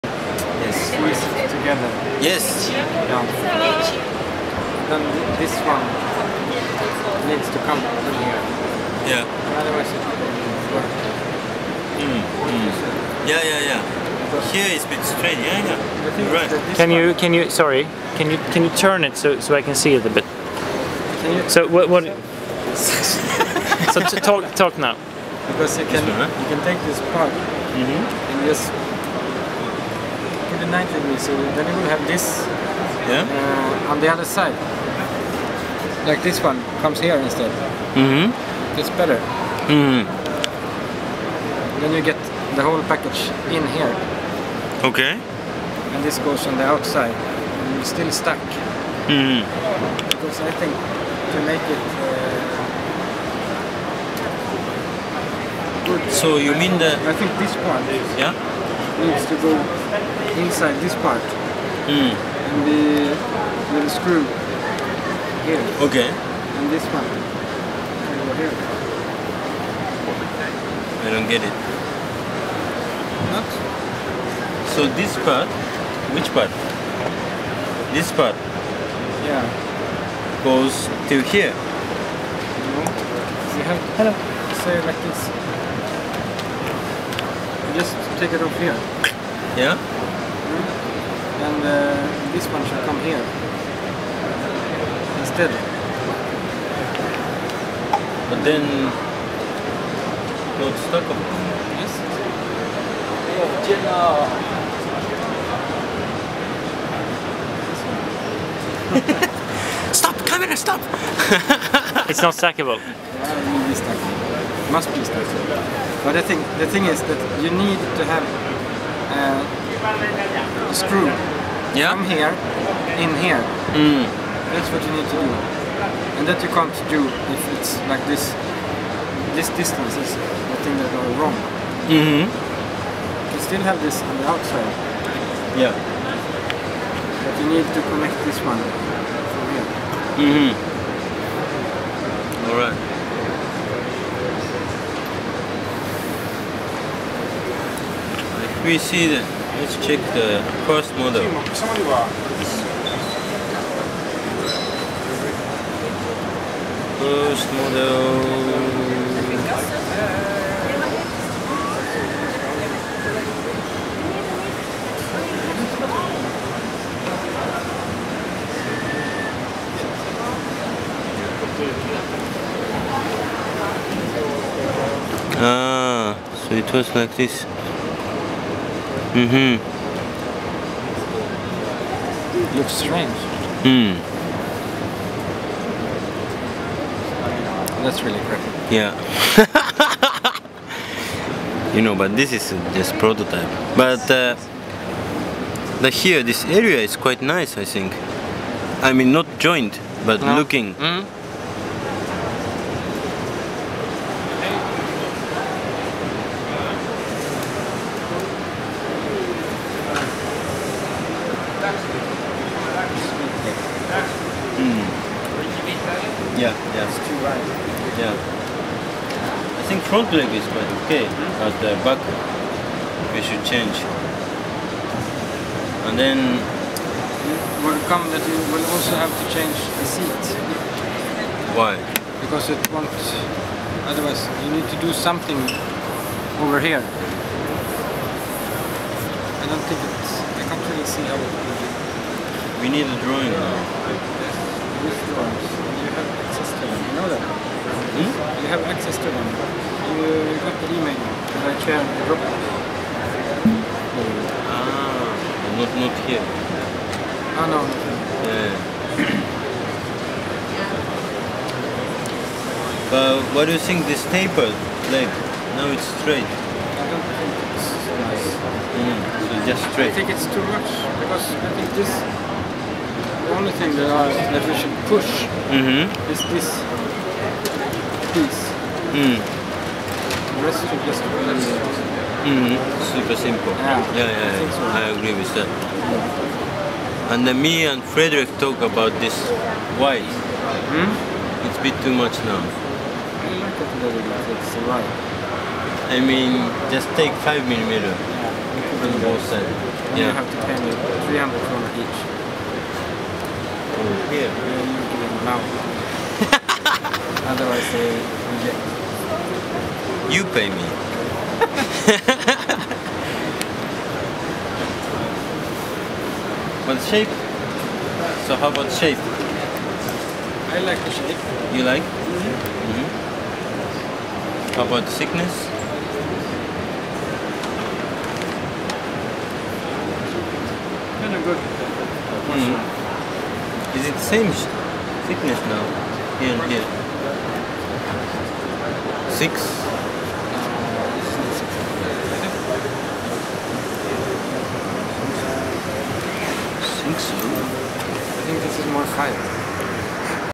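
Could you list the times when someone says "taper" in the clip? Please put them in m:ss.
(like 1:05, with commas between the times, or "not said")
4:24.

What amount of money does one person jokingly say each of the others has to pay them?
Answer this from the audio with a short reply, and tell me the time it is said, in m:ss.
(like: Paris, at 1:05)
300 kroner, at 5:01.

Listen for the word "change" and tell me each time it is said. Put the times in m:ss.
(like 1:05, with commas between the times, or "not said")
3:43, 3:49.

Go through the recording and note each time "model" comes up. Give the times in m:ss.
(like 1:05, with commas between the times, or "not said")
2:30, 2:37.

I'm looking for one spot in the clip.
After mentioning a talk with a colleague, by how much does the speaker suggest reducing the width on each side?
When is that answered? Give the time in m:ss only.
4:57.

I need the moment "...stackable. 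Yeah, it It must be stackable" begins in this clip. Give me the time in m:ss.
1:52.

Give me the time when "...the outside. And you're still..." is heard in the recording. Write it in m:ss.
0:46.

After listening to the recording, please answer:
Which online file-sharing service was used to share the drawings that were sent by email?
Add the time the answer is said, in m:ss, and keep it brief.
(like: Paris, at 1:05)
Dropbox, at 4:12.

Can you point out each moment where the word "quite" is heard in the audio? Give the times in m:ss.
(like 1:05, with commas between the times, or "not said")
3:16, 3:40.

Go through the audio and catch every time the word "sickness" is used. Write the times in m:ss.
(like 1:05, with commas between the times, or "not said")
5:24, 5:35.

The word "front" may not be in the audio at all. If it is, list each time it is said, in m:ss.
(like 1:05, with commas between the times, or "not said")
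3:39.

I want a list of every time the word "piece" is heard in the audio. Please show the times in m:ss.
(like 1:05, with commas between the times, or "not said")
4:38.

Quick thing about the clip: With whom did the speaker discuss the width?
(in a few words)
Frederick.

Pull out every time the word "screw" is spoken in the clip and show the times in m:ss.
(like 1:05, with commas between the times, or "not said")
1:03, 2:00.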